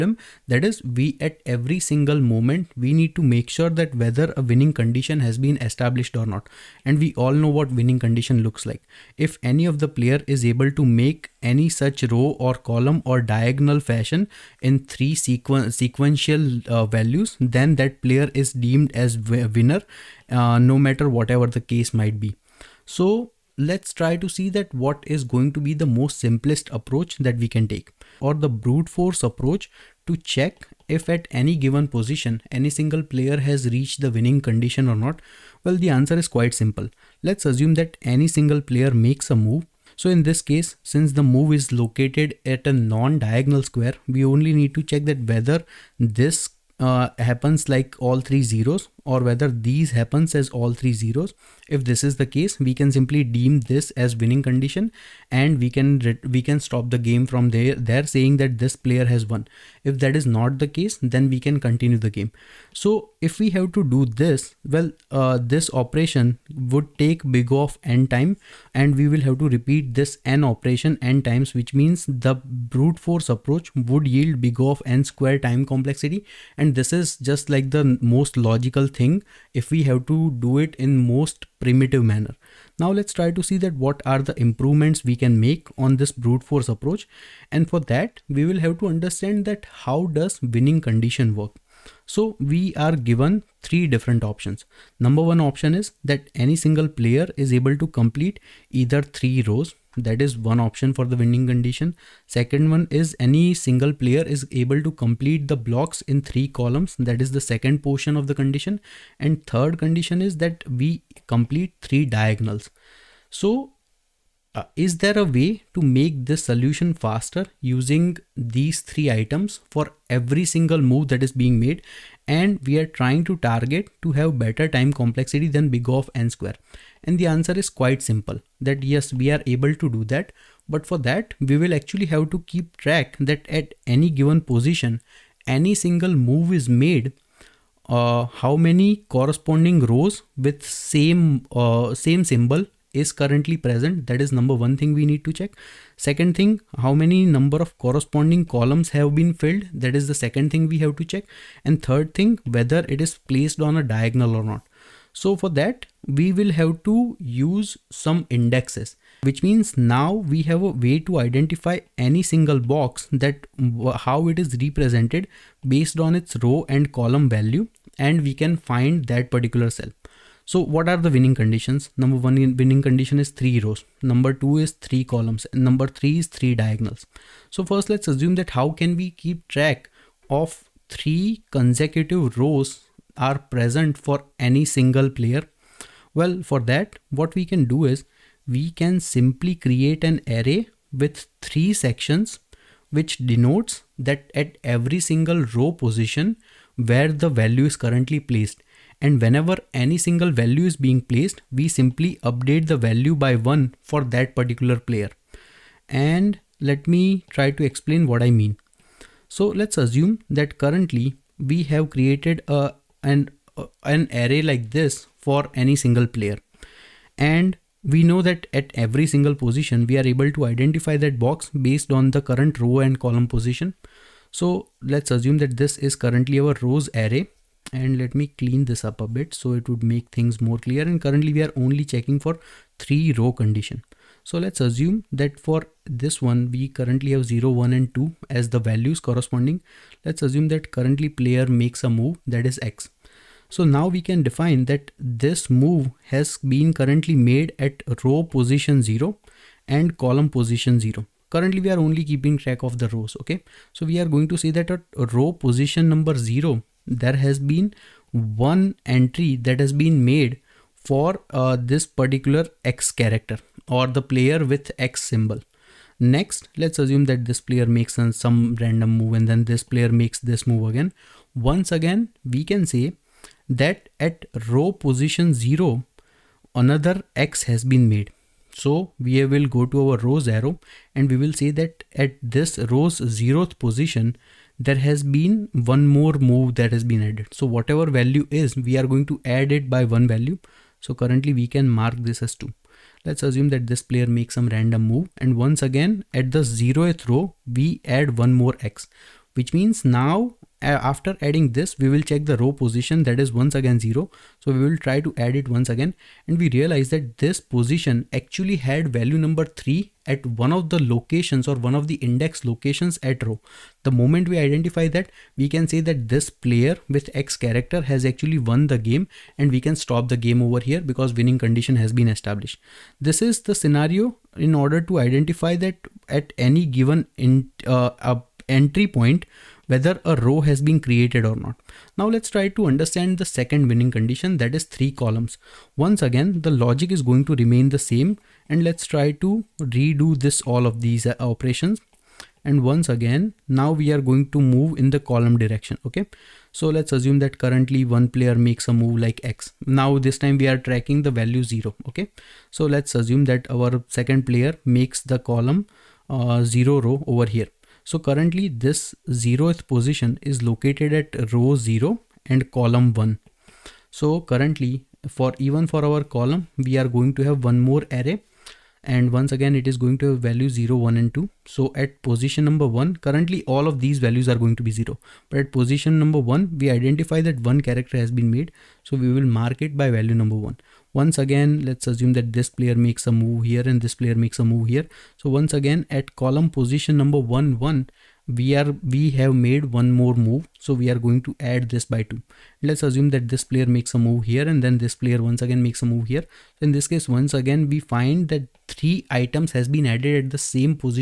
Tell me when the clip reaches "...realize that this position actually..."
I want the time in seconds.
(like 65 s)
306 s.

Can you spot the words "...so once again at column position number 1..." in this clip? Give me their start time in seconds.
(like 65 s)
385 s.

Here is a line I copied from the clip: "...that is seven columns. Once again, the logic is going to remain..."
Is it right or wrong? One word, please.
wrong.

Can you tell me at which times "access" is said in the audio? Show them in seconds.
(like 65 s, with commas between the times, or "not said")
not said.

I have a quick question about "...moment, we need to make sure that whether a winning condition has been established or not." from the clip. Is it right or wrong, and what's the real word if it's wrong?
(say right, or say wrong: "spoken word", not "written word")
right.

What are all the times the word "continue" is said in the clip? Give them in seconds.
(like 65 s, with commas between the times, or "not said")
61 s.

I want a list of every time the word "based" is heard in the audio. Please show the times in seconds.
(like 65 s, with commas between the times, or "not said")
165 s, 221 s.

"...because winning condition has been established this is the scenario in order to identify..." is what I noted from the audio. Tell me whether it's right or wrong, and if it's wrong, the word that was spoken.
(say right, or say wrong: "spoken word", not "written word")
right.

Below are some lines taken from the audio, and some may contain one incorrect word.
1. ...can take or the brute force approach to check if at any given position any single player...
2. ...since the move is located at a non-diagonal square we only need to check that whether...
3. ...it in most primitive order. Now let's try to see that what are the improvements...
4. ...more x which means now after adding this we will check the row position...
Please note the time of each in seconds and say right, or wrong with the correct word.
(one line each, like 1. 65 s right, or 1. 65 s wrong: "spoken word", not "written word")
1. 27 s right
2. 40 s right
3. 80 s wrong: "manner", not "order"
4. 298 s right.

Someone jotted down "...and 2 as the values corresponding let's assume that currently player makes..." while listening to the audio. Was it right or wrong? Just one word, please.
right.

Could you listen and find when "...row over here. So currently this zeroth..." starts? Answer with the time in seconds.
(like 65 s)
356 s.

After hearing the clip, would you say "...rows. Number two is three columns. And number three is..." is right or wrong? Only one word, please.
right.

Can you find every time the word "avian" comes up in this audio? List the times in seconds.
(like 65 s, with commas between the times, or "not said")
not said.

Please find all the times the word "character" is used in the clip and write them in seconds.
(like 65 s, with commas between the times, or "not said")
262 s, 317 s, 377 s.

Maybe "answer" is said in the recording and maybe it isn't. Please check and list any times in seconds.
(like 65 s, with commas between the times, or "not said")
35 s, 127 s.